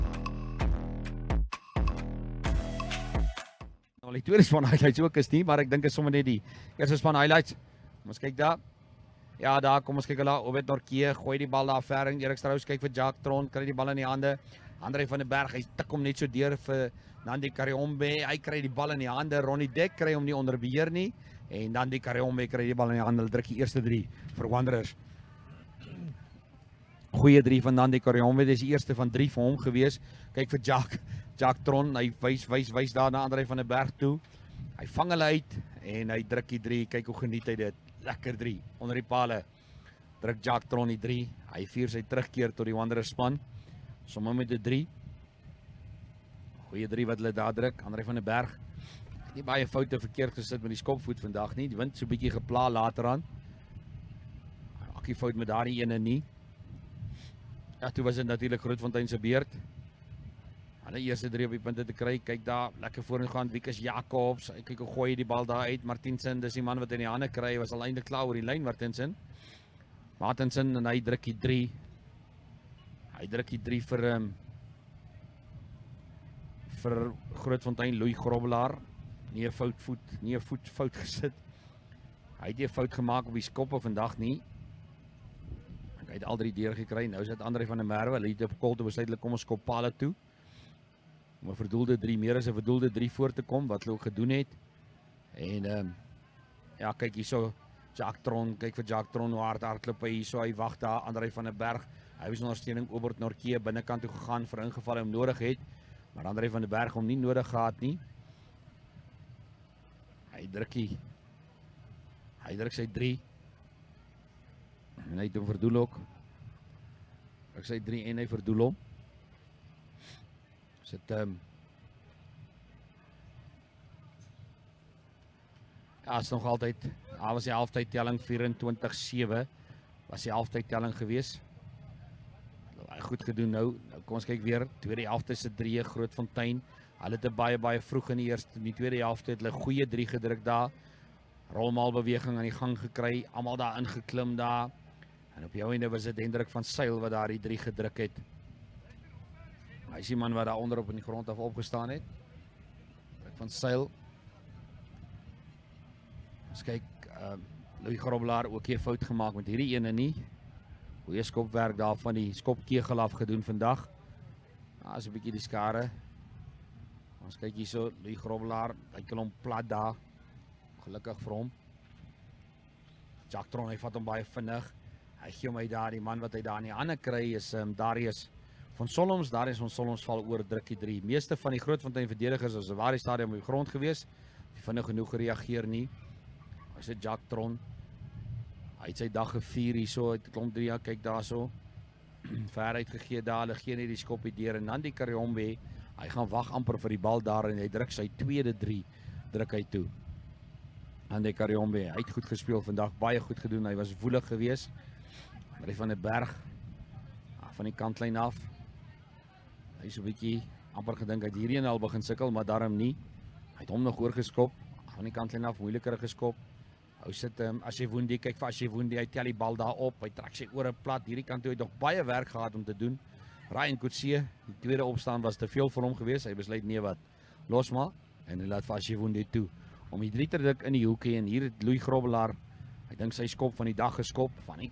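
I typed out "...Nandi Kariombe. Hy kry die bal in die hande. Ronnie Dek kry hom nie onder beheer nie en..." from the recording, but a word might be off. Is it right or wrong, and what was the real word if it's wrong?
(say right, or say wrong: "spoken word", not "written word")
right.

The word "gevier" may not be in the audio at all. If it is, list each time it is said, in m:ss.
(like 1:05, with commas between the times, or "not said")
3:09.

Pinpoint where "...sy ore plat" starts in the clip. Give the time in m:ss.
3:40.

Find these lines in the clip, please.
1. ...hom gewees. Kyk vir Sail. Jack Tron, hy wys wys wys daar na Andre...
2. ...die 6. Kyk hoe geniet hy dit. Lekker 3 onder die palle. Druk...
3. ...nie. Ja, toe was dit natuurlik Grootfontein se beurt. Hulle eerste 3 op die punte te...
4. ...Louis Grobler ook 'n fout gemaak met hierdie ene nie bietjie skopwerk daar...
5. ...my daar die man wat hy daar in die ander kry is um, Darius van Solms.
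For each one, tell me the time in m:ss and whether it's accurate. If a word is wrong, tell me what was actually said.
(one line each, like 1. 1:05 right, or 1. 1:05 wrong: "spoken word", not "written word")
1. 0:29 wrong: "Jack", not "Sail"
2. 0:36 wrong: "3", not "6"
3. 0:55 right
4. 2:37 wrong: "goeie", not "bietjie"
5. 2:55 right.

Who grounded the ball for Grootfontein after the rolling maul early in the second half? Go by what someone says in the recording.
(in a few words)
Hendrik van Sail.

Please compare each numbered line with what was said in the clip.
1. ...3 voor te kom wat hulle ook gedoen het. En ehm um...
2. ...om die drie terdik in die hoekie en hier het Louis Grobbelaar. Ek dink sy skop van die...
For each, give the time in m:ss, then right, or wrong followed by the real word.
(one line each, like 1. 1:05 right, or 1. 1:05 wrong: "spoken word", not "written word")
1. 1:32 right
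2. 3:49 right.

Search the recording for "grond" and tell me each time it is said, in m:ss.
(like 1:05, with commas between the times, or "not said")
2:31, 3:03.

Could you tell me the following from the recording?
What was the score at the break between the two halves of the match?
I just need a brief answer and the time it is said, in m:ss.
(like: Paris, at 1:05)
24-7, at 2:08.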